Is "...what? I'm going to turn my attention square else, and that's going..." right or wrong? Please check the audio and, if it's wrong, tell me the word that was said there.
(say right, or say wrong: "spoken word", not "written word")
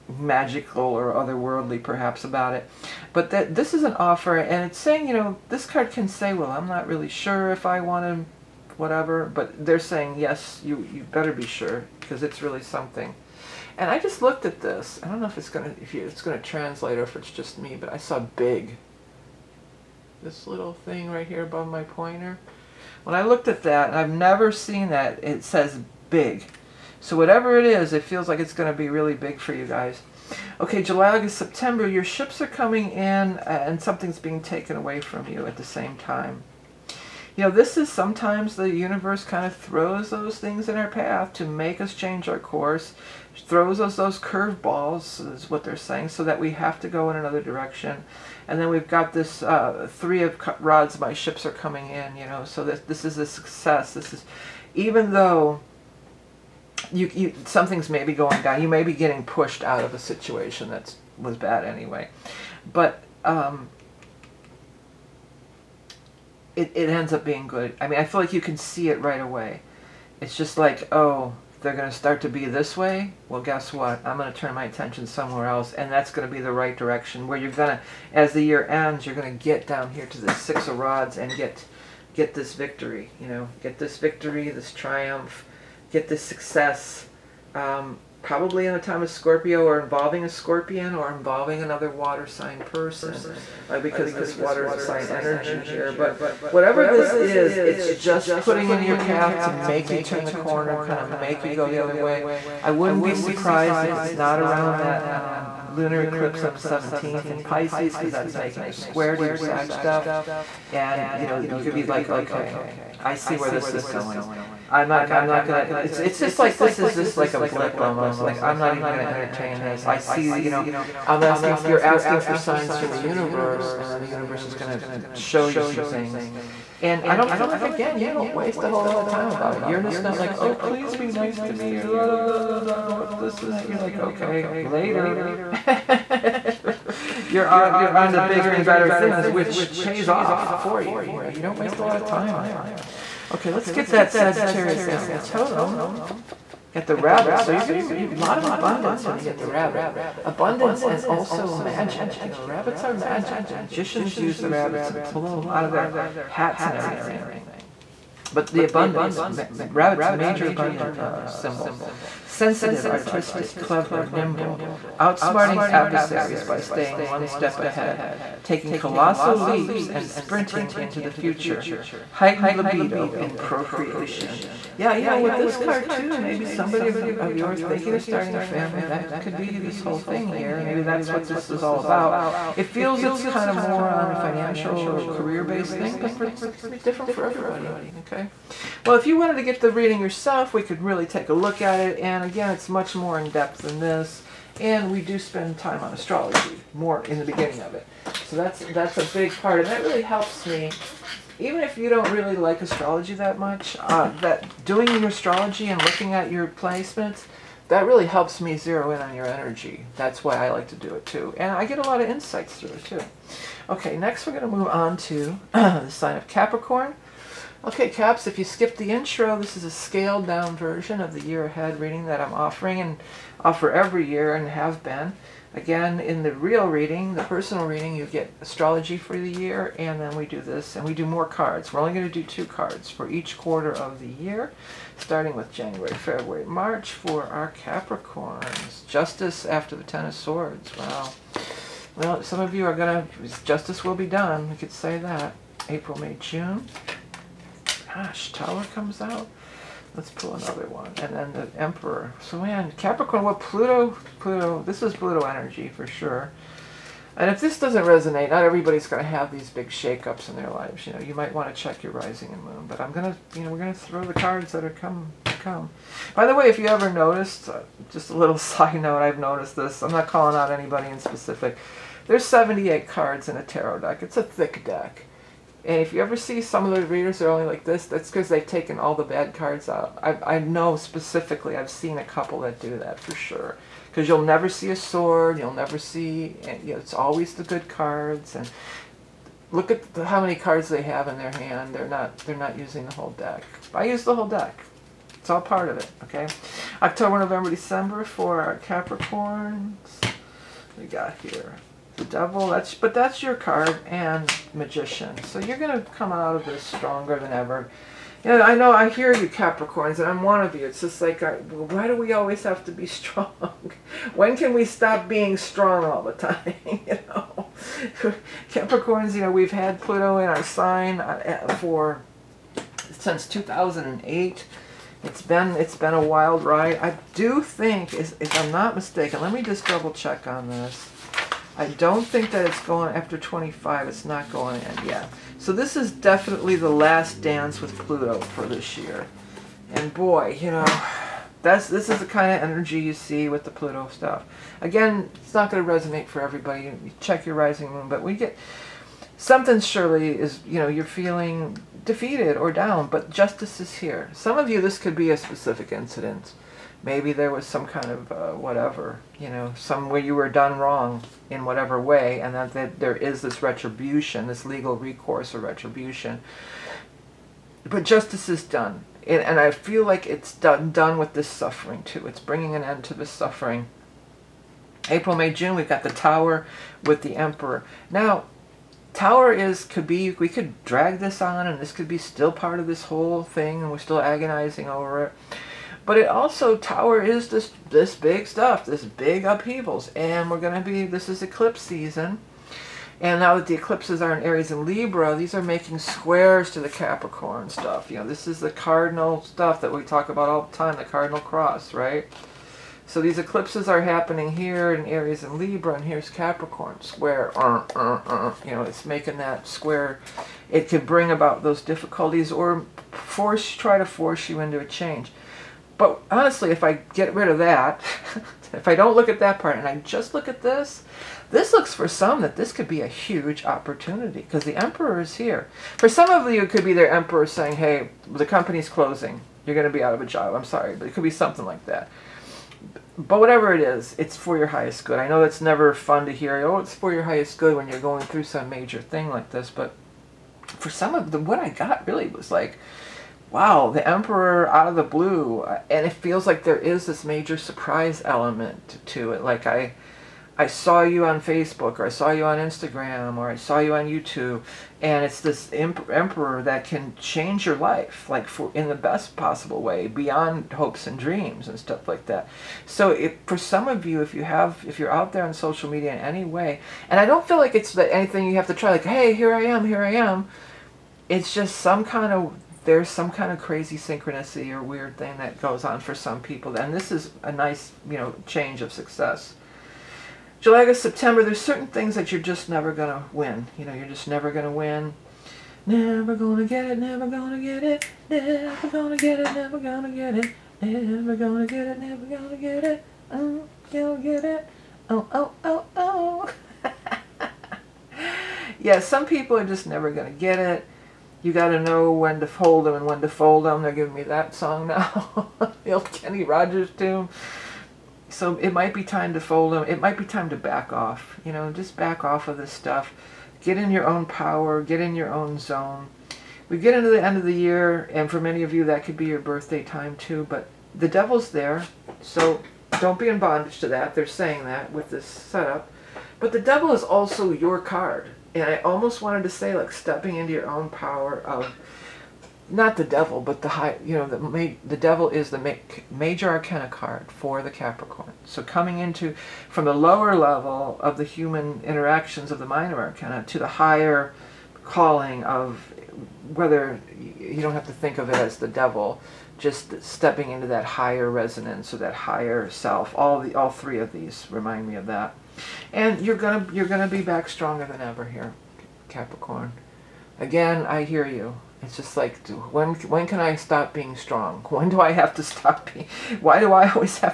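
wrong: "somewhere", not "square".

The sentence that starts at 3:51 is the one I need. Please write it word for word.
We're only going to do two cards for each quarter of the year, starting with January, February, March for our Capricorns.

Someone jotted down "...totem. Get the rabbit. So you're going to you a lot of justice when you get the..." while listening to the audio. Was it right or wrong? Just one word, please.
wrong.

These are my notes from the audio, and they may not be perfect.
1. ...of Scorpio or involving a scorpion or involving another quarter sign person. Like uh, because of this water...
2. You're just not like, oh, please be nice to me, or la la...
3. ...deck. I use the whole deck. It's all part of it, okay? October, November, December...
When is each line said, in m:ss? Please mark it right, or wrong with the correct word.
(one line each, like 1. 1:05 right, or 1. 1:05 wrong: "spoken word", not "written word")
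1. 1:29 wrong: "water", not "quarter"
2. 2:09 right
3. 4:53 right.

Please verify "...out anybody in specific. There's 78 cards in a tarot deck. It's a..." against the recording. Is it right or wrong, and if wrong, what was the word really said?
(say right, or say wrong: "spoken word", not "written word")
right.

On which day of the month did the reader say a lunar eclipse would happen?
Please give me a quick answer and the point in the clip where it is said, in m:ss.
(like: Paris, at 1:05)
17th, at 1:46.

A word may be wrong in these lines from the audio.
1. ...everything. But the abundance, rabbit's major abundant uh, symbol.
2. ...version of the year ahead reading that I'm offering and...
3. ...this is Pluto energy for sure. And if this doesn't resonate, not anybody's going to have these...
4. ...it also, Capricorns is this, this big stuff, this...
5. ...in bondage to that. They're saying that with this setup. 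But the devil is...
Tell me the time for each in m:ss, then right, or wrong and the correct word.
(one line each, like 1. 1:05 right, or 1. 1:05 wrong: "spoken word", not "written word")
1. 2:36 right
2. 3:40 right
3. 4:14 wrong: "everybody", not "anybody"
4. 6:25 wrong: "Tower", not "Capricorns"
5. 8:43 right.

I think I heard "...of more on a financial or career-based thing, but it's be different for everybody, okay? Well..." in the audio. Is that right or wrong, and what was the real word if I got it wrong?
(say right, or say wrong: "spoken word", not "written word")
right.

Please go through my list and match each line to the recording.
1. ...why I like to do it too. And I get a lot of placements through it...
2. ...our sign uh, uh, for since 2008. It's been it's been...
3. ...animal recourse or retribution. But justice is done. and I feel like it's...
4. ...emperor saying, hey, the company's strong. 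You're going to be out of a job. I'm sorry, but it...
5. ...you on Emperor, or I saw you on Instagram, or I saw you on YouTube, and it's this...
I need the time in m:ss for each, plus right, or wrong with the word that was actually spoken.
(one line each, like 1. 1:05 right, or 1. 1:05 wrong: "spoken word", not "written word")
1. 3:30 wrong: "insights", not "placements"
2. 5:20 right
3. 6:04 wrong: "legal", not "animal"
4. 7:06 wrong: "closing", not "strong"
5. 7:30 wrong: "Facebook", not "Emperor".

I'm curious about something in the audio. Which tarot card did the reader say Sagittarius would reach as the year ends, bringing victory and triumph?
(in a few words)
Six of Rods.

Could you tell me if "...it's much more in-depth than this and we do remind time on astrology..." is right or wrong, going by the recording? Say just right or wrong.
wrong.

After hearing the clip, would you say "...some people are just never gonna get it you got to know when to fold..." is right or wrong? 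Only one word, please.
right.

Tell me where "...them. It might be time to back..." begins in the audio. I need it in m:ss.
8:29.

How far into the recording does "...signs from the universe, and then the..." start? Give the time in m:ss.
2:02.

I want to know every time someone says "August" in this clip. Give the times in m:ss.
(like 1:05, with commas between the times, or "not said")
0:31, 8:00.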